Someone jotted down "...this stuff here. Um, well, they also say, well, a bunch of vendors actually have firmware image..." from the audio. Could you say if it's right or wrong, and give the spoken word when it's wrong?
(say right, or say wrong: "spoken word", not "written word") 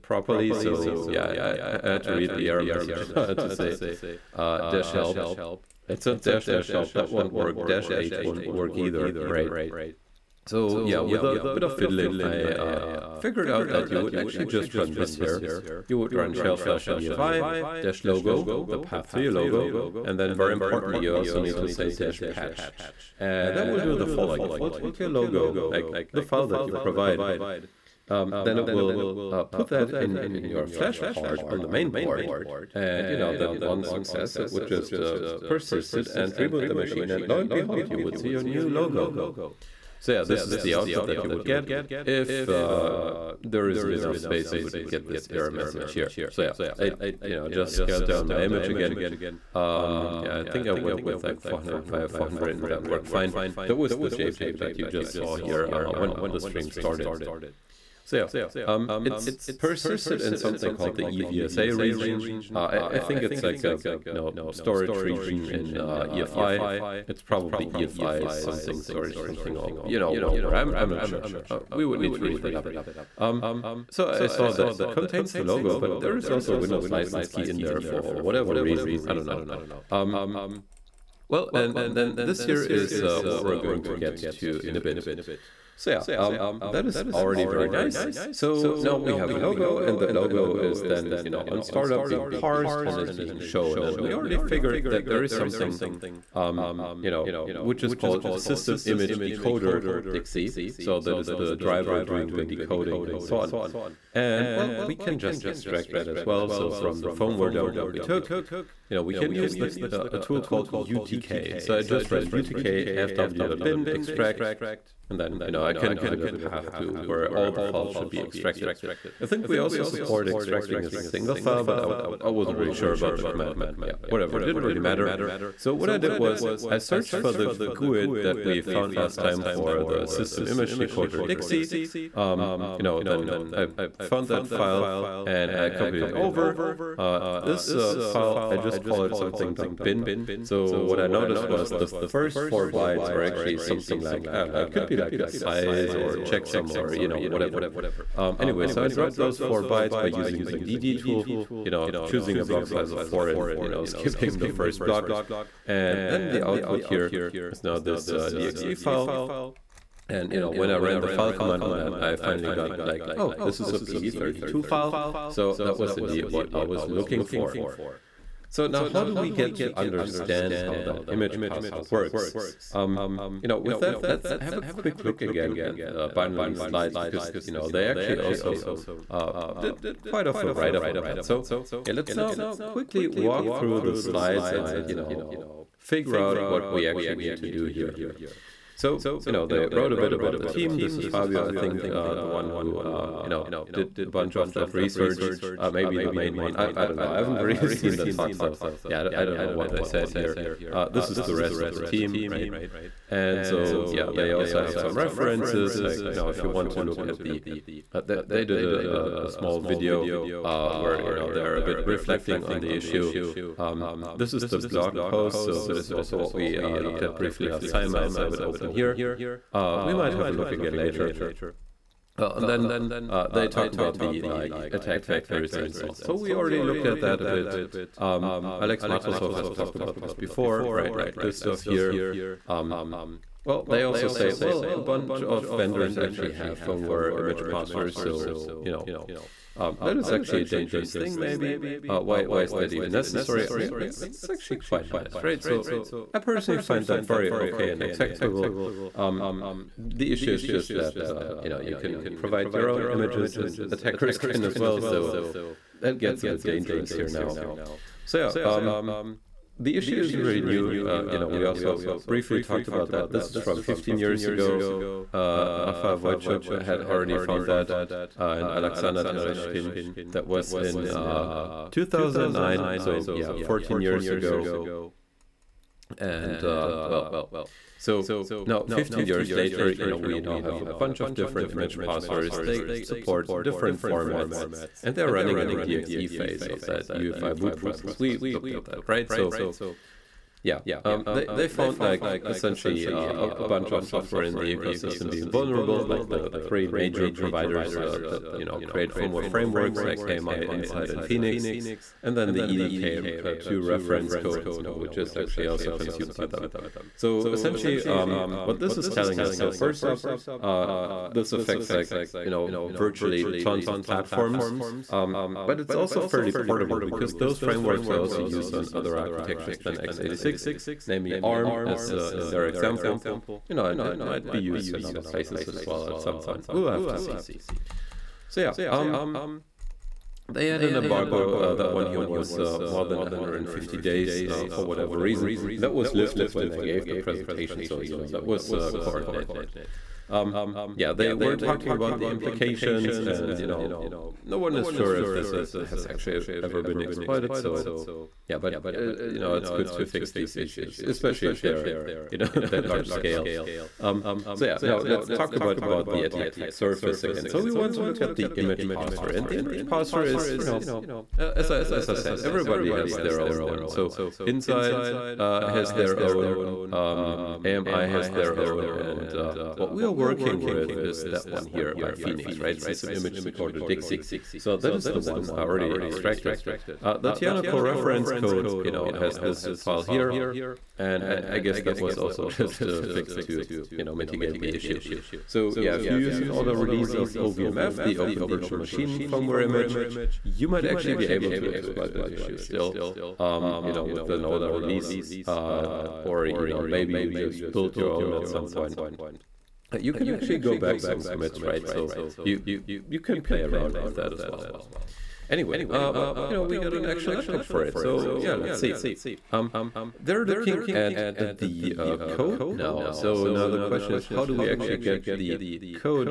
right.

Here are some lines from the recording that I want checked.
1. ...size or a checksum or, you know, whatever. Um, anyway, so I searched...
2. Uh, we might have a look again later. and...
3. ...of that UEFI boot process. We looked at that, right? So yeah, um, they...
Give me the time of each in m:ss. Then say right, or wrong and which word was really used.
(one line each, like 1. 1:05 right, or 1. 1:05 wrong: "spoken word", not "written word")
1. 2:25 wrong: "dropped", not "searched"
2. 3:39 right
3. 4:46 right.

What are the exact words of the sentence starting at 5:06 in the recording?
So essentially, um, what this is telling us.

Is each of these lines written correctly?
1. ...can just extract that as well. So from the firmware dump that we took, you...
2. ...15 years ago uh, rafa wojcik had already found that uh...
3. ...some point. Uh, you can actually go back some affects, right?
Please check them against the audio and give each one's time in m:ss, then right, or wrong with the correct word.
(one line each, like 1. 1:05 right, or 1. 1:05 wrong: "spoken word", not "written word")
1. 1:44 right
2. 4:23 right
3. 6:38 wrong: "commits", not "affects".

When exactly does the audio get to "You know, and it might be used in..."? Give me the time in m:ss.
5:23.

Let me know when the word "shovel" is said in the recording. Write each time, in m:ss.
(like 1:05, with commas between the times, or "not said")
not said.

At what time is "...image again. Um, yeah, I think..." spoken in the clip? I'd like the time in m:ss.
0:48.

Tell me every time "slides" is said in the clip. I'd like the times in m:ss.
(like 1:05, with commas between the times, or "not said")
2:56, 3:03.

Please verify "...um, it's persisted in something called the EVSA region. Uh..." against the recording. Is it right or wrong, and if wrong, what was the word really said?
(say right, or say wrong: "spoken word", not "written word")
right.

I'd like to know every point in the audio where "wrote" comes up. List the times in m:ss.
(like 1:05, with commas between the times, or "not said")
3:09.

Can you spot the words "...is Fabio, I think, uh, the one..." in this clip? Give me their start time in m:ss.
3:10.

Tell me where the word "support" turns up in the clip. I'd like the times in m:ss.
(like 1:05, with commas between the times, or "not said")
1:59, 4:42.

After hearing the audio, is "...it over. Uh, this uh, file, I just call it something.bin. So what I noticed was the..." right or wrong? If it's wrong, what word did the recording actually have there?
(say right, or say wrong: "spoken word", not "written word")
right.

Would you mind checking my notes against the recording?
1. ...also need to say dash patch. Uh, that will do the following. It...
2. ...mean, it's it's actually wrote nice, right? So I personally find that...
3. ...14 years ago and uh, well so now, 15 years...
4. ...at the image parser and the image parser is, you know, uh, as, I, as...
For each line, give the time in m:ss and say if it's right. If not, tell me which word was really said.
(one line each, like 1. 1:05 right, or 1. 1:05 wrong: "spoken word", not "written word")
1. 0:21 right
2. 4:03 wrong: "quite", not "wrote"
3. 4:33 right
4. 5:58 right.